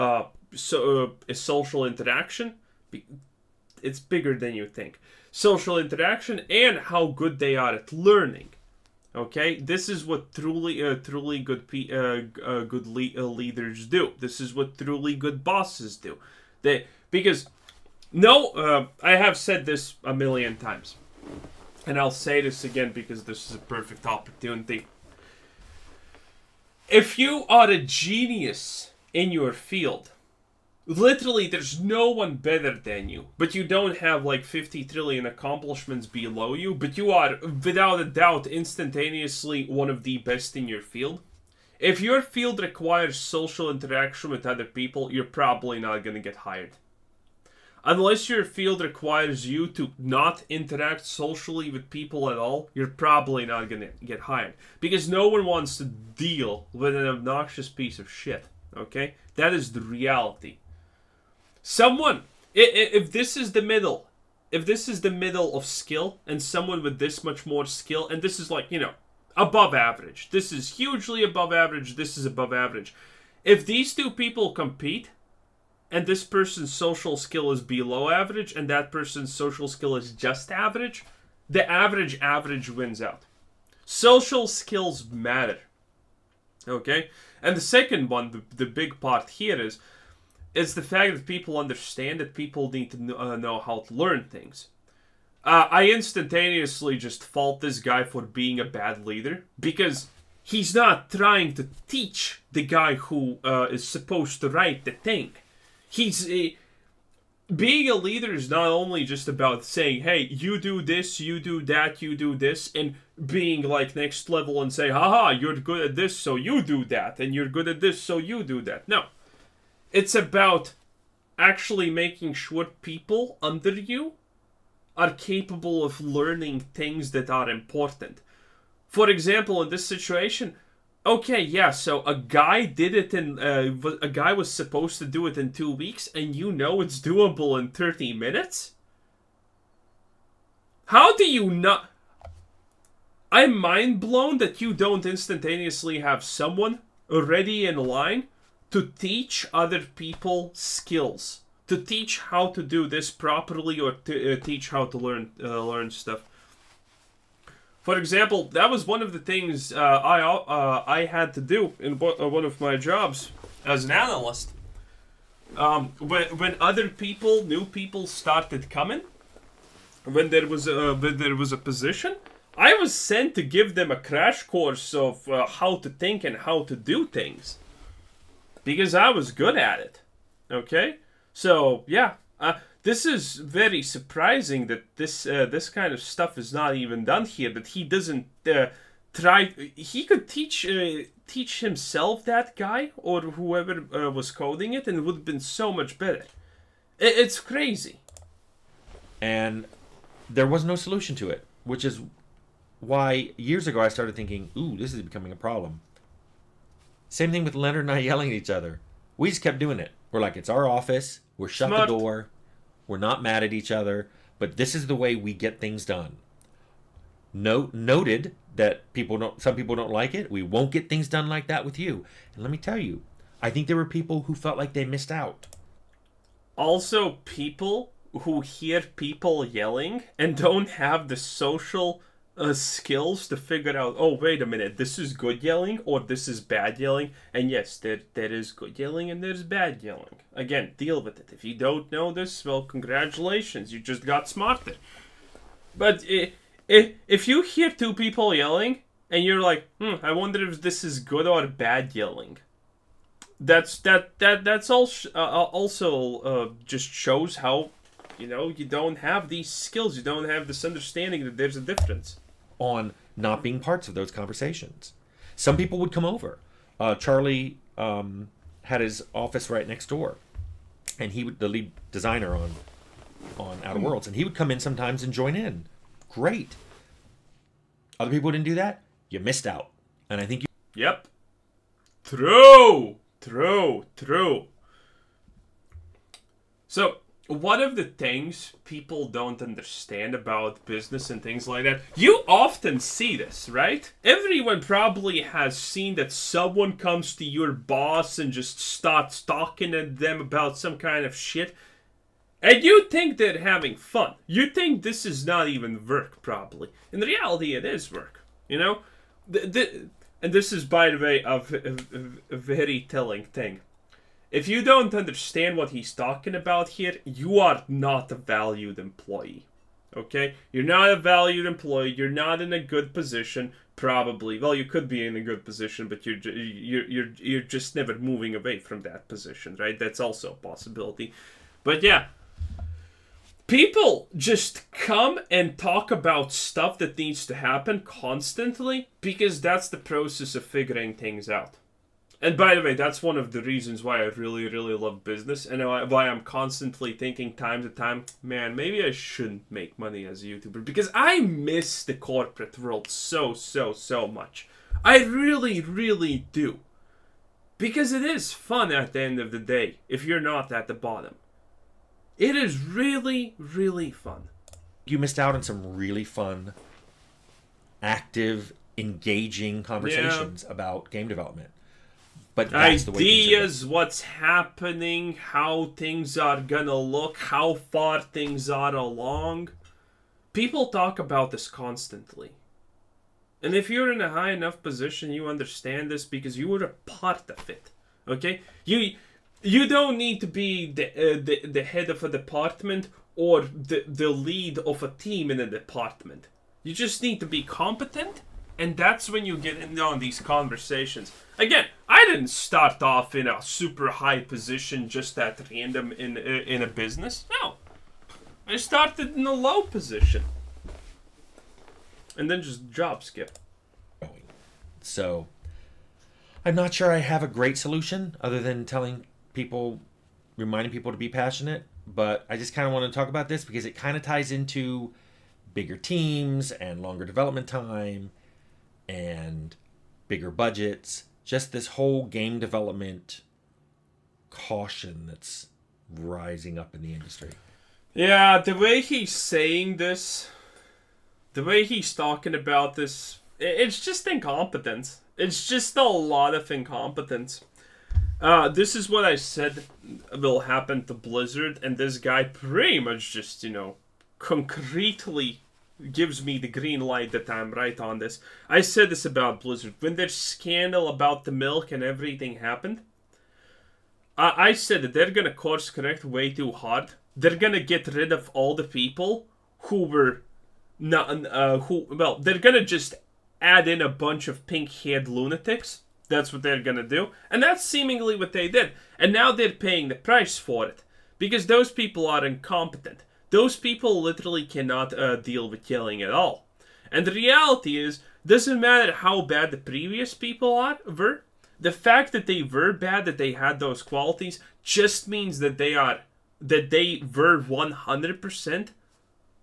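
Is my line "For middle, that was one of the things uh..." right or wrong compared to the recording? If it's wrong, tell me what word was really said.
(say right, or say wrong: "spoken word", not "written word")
wrong: "example", not "middle".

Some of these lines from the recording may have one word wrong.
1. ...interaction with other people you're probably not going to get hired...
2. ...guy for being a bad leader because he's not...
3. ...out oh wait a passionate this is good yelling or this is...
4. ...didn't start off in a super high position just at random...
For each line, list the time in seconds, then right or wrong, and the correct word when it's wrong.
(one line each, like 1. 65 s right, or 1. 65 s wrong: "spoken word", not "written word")
1. 43 s right
2. 97 s right
3. 233 s wrong: "minute", not "passionate"
4. 402 s right.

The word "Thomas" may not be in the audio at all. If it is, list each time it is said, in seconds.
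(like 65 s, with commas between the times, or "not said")
not said.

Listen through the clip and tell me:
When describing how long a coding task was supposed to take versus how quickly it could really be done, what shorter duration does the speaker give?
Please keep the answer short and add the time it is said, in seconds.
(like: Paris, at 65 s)
30 minutes, at 137 s.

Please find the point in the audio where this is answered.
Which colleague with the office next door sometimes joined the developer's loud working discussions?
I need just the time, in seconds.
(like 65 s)
266 s.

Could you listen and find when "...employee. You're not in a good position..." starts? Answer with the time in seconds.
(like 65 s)
321 s.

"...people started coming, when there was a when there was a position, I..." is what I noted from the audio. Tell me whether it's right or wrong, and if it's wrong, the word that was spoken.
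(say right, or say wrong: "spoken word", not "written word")
right.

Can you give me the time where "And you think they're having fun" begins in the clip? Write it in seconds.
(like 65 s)
302 s.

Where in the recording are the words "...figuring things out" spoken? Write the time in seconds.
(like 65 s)
340 s.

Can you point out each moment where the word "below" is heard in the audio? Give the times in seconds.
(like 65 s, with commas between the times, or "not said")
36 s, 77 s.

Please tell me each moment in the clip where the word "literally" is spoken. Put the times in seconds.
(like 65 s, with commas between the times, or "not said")
30 s, 484 s.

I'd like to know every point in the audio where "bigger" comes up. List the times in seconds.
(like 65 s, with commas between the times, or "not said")
3 s, 425 s, 430 s.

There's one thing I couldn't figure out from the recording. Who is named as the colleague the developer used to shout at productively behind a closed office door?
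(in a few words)
Leonard.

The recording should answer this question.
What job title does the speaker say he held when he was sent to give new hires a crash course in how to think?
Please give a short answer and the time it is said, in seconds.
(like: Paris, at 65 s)
analyst, at 163 s.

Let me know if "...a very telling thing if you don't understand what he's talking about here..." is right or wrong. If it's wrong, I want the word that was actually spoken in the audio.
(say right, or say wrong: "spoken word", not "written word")
right.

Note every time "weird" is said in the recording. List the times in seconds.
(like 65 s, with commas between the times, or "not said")
not said.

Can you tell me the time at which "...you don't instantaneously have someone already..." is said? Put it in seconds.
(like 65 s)
144 s.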